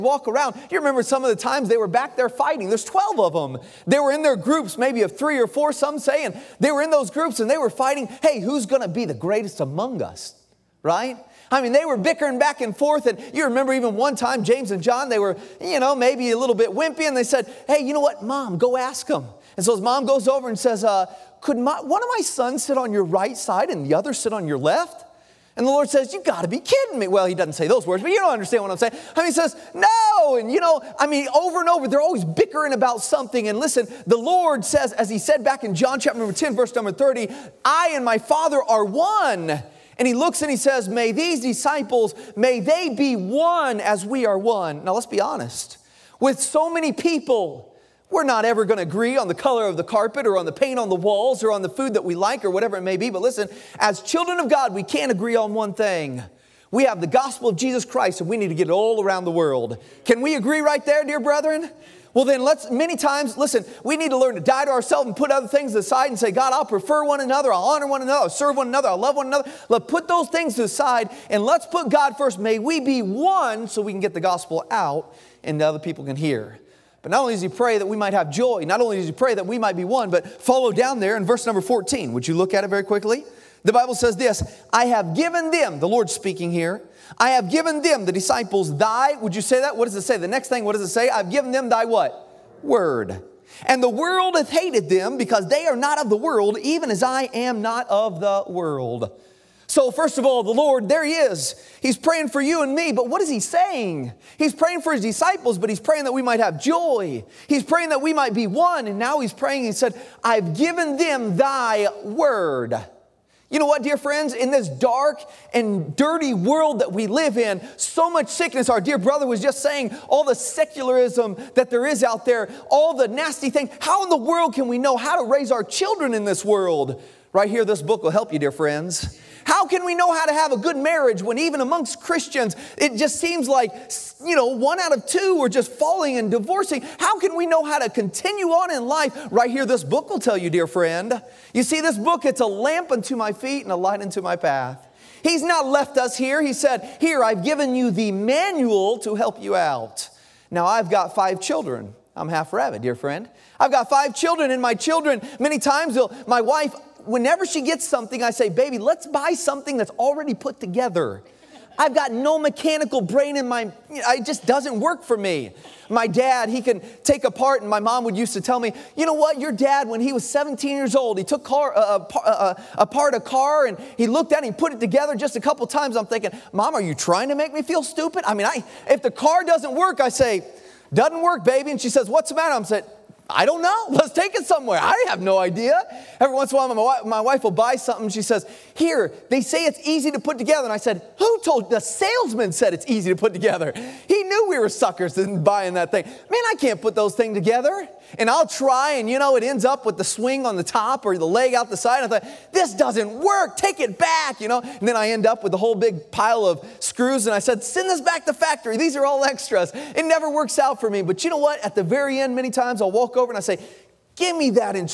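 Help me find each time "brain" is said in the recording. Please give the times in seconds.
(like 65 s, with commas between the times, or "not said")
163 s.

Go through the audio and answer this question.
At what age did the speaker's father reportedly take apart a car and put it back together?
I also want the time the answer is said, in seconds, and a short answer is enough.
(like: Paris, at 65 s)
17, at 170 s.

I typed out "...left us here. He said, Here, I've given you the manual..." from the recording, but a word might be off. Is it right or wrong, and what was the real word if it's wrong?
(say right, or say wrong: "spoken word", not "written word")
right.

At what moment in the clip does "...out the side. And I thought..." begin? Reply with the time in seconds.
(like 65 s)
201 s.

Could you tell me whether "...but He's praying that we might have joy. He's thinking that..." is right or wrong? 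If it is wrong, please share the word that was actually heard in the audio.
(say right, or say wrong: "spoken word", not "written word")
wrong: "praying", not "thinking".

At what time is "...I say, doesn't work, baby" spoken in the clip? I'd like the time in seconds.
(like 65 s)
179 s.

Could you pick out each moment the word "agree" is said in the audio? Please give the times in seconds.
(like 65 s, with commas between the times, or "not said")
48 s, 55 s, 60 s.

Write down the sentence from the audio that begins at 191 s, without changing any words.
The salesman said it's easy to put together.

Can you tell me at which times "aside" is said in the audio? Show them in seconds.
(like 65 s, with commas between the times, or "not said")
65 s, 70 s.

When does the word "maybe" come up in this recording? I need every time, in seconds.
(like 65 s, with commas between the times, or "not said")
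4 s, 15 s.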